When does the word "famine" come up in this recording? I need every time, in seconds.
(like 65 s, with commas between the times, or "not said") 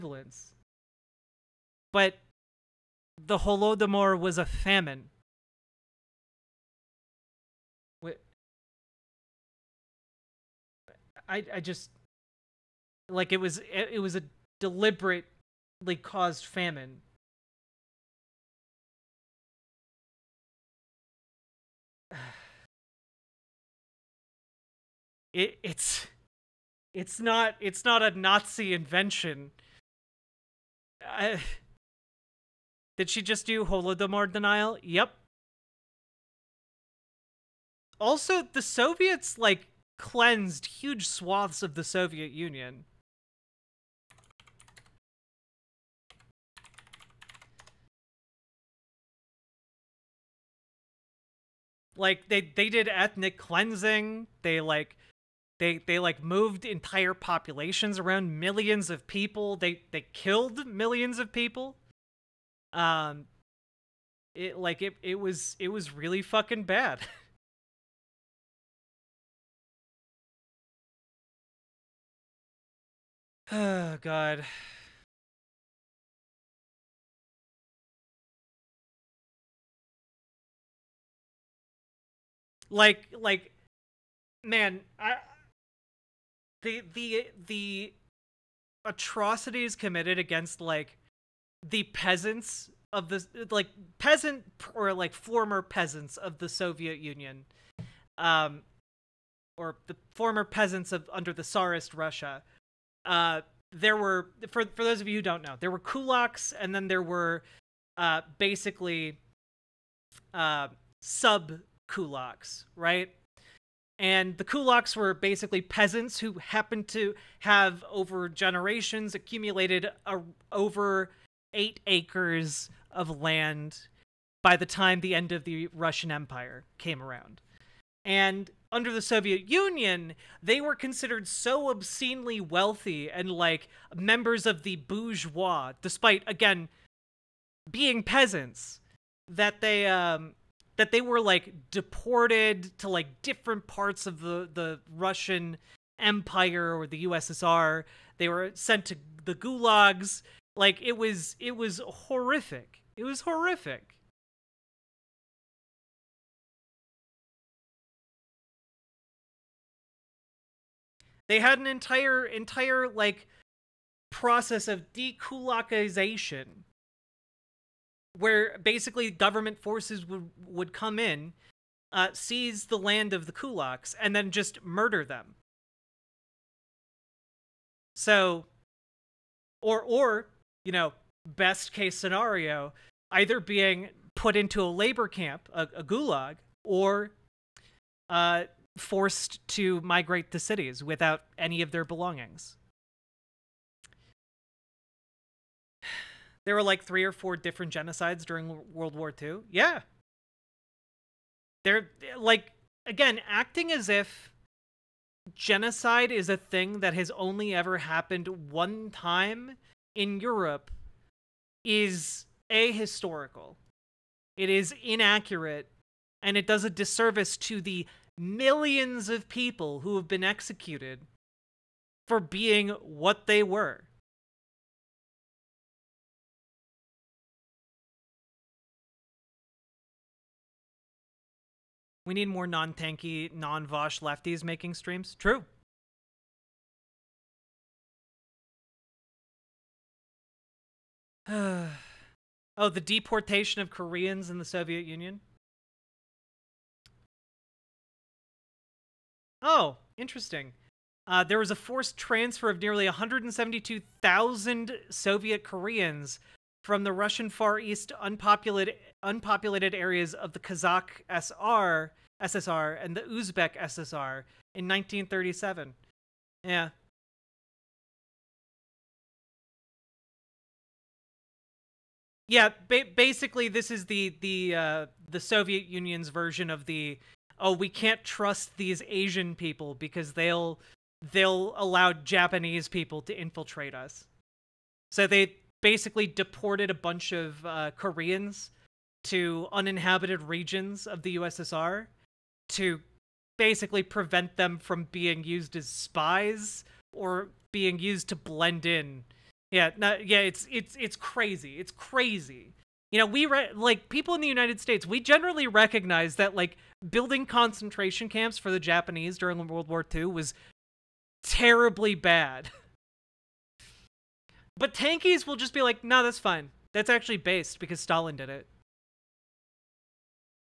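4 s, 16 s.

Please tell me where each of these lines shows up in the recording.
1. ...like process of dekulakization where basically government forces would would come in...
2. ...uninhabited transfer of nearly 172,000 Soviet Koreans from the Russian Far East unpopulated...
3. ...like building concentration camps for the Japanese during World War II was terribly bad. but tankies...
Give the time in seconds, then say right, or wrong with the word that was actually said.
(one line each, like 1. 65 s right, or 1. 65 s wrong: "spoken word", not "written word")
1. 162 s right
2. 251 s wrong: "forced", not "uninhabited"
3. 306 s right.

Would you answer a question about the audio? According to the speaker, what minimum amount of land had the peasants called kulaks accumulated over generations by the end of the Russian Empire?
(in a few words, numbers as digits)
over 8 acres.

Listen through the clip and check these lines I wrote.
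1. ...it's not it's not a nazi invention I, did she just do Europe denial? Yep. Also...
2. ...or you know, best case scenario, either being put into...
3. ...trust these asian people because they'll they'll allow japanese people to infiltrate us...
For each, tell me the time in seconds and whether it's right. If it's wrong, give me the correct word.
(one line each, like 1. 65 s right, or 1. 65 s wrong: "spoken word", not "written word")
1. 26 s wrong: "Holodomor", not "Europe"
2. 179 s right
3. 278 s right.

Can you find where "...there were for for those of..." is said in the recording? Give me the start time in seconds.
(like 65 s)
103 s.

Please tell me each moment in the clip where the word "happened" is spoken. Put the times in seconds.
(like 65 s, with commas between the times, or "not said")
116 s, 207 s.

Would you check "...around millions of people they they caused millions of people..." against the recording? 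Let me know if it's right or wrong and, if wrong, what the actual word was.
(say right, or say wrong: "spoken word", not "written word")
wrong: "killed", not "caused".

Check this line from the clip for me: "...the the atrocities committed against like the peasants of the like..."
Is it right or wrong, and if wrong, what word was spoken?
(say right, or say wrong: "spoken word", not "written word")
right.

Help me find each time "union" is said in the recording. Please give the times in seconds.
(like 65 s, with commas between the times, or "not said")
42 s, 96 s, 129 s, 244 s, 275 s.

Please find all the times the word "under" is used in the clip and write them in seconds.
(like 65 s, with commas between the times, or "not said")
101 s, 128 s.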